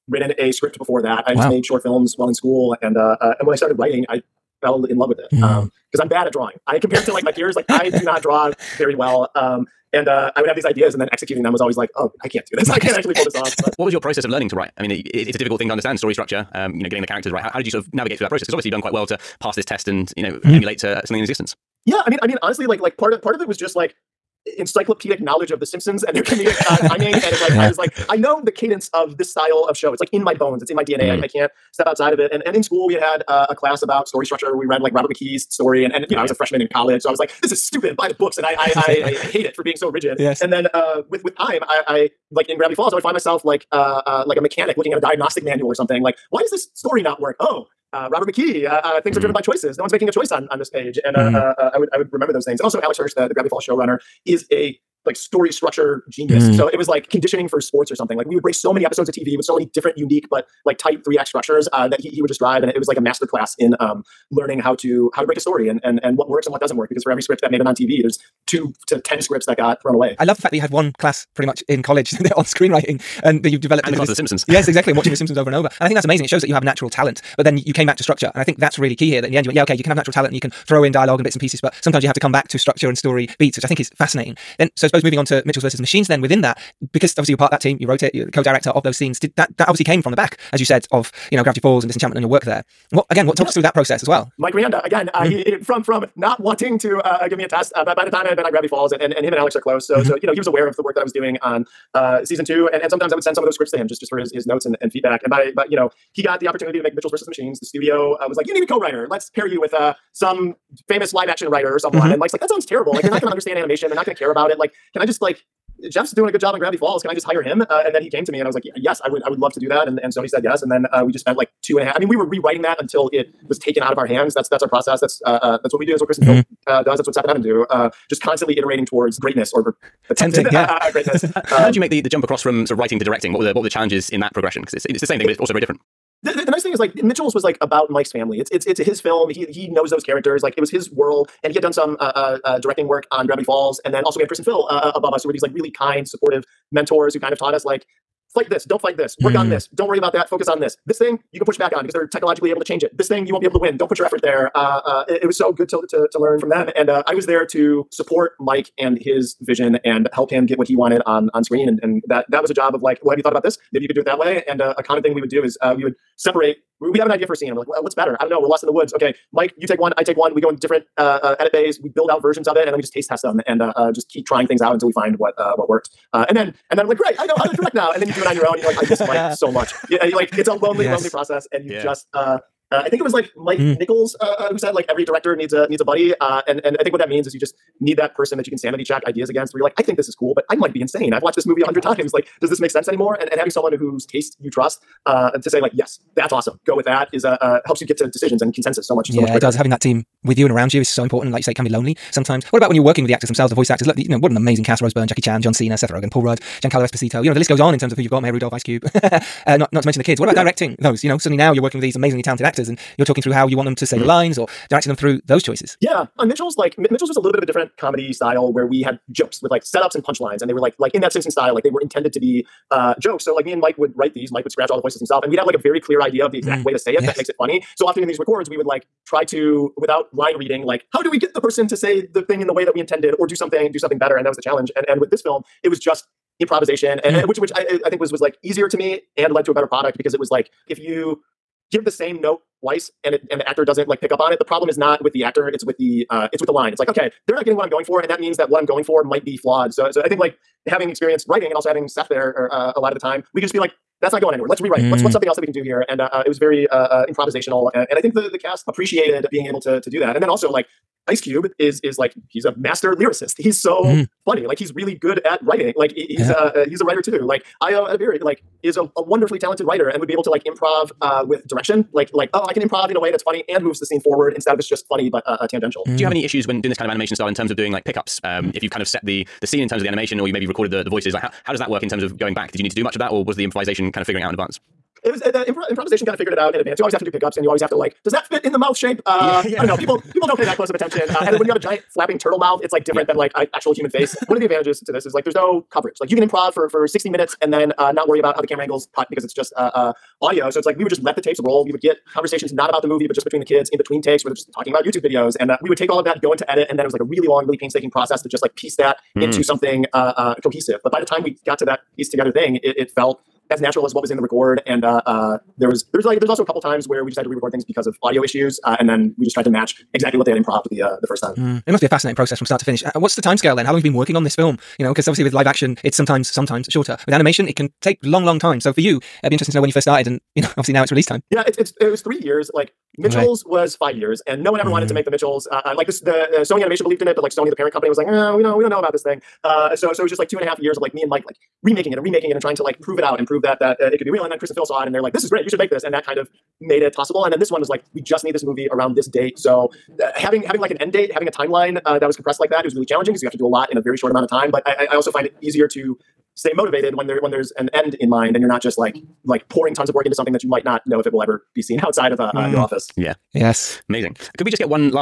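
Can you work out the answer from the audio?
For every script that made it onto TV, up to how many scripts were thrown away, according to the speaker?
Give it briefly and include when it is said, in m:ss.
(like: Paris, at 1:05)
10, at 1:09.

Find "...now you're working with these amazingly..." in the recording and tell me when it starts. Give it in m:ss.
3:31.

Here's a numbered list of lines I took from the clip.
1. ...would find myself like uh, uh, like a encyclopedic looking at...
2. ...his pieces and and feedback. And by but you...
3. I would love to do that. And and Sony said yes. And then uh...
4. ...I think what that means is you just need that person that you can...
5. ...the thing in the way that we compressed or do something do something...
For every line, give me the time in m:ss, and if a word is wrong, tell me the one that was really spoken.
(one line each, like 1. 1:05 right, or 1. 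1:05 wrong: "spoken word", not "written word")
1. 0:42 wrong: "mechanic", not "encyclopedic"
2. 1:44 wrong: "notes", not "pieces"
3. 1:59 right
4. 3:06 right
5. 3:52 wrong: "intended", not "compressed".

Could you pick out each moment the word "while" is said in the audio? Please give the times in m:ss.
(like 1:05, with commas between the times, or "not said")
0:02.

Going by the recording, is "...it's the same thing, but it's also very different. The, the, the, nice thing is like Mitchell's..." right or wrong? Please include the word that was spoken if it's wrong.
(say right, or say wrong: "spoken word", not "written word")
right.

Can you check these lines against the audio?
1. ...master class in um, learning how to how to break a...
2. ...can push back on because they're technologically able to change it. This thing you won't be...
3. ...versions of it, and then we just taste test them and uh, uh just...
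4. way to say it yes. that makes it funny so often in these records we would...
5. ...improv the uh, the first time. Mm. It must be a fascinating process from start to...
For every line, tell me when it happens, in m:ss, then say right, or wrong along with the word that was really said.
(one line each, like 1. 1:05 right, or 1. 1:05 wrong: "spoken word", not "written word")
1. 1:02 right
2. 2:31 right
3. 2:52 right
4. 3:46 right
5. 5:20 right.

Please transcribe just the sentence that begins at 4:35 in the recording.
do you have any issues when doing this kind of animation style in terms of doing like pickups um, mm.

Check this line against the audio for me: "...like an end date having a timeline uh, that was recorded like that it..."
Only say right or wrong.
wrong.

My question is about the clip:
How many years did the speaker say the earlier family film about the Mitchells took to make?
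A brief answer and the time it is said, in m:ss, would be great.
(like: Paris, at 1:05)
5, at 5:33.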